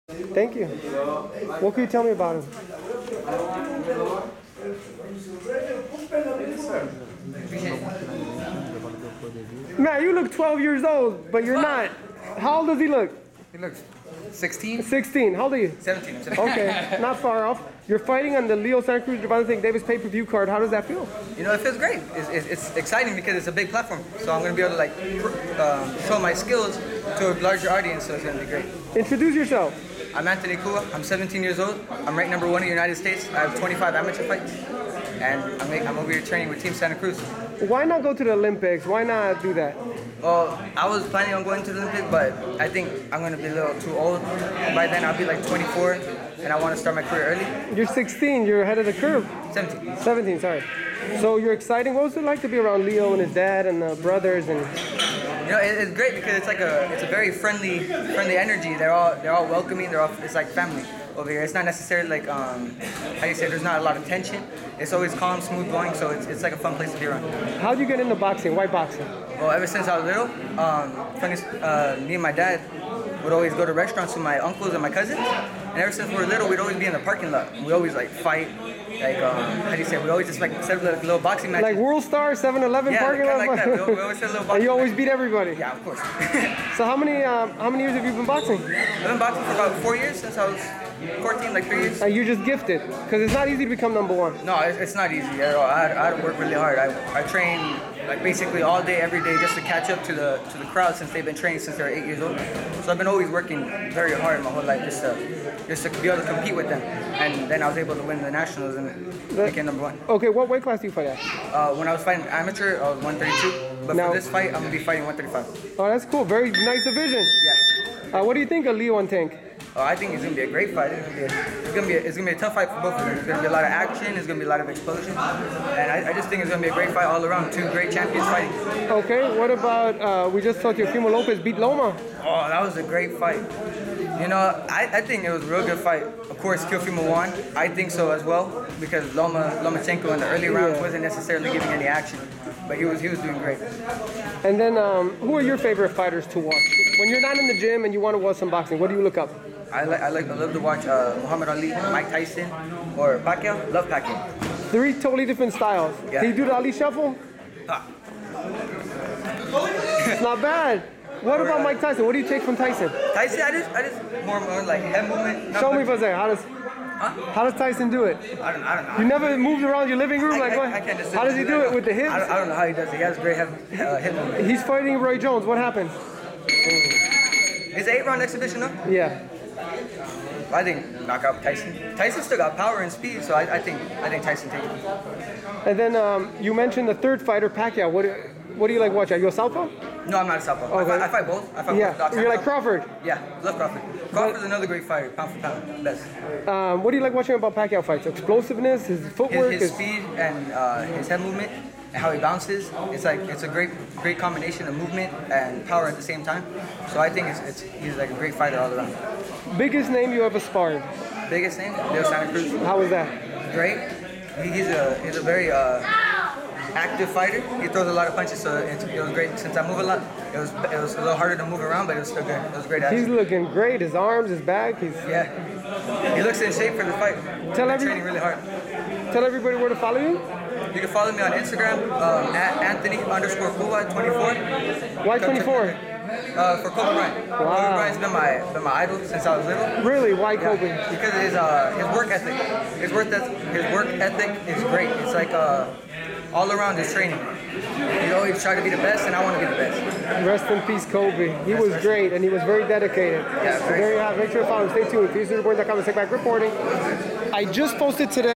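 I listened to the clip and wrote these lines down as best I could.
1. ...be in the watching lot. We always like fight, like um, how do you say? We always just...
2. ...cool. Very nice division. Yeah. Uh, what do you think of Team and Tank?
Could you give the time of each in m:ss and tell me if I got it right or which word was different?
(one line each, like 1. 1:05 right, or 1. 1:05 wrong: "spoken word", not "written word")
1. 1:16 wrong: "parking", not "watching"
2. 1:56 wrong: "Leo", not "Team".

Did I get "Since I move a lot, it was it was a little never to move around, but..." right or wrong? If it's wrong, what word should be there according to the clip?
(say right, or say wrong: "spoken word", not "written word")
wrong: "harder", not "never".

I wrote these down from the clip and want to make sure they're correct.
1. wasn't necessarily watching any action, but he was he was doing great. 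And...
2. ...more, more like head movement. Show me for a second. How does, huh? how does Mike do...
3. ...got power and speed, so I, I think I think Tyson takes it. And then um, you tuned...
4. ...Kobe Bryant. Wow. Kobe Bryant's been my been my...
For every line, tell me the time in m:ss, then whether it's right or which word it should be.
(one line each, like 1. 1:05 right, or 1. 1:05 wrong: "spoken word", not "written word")
1. 2:20 wrong: "giving", not "watching"
2. 2:44 wrong: "Tyson", not "Mike"
3. 3:02 wrong: "mentioned", not "tuned"
4. 3:56 right.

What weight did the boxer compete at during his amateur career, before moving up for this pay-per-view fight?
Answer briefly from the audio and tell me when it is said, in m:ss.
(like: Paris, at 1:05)
132, at 1:53.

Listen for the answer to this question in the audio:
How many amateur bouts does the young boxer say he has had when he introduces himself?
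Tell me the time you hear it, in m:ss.
0:33.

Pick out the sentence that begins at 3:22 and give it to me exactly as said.
It's like it's a great, great combination of movement and power at the same time.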